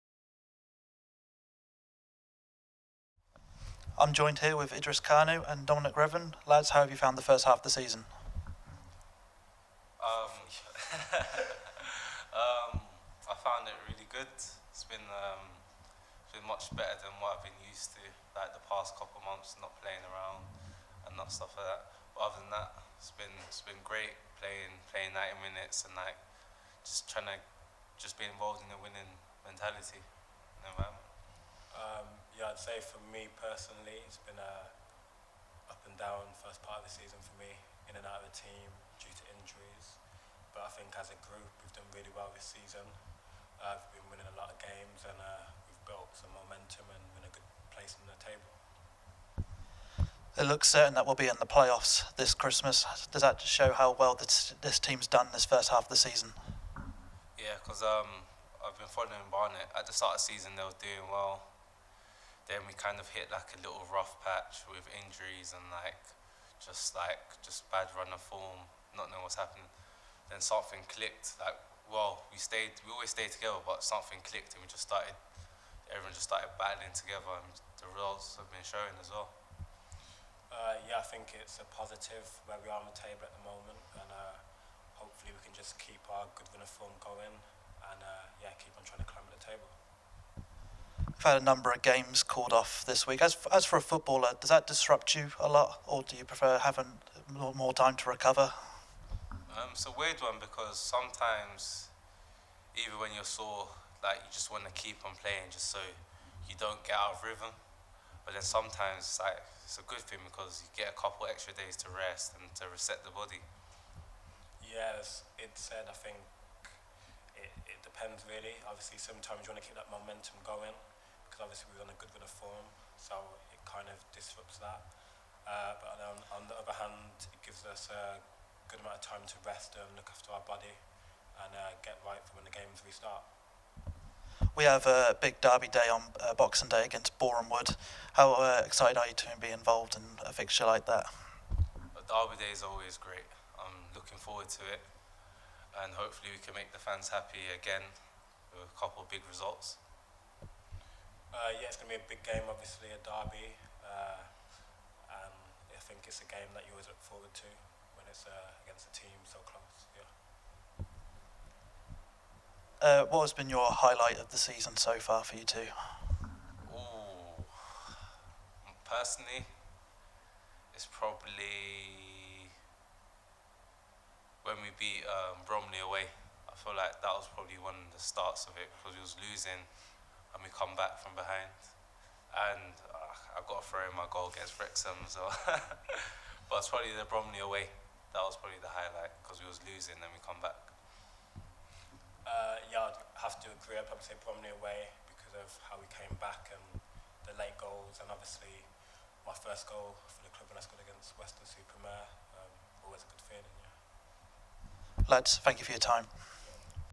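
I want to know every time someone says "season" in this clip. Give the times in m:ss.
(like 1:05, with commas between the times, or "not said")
0:07, 0:36, 0:42, 0:55, 1:00, 2:44.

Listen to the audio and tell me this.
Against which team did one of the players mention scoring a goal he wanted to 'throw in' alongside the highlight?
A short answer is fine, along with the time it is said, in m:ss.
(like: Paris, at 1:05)
Wrexham, at 3:04.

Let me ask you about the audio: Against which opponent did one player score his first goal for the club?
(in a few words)
Weston-super-Mare.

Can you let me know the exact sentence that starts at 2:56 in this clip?
I feel like that was probably one of the starts of it because we was losing and we come back from behind.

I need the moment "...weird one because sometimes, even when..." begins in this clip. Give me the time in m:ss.
1:39.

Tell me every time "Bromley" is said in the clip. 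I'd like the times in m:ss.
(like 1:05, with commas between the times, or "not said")
2:55, 3:07, 3:14.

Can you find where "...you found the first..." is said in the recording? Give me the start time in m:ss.
0:06.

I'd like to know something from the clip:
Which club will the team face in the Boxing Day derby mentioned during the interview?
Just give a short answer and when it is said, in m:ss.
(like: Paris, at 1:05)
Boreham Wood, at 2:17.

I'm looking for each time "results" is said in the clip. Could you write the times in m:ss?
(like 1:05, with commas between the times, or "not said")
1:17, 2:29.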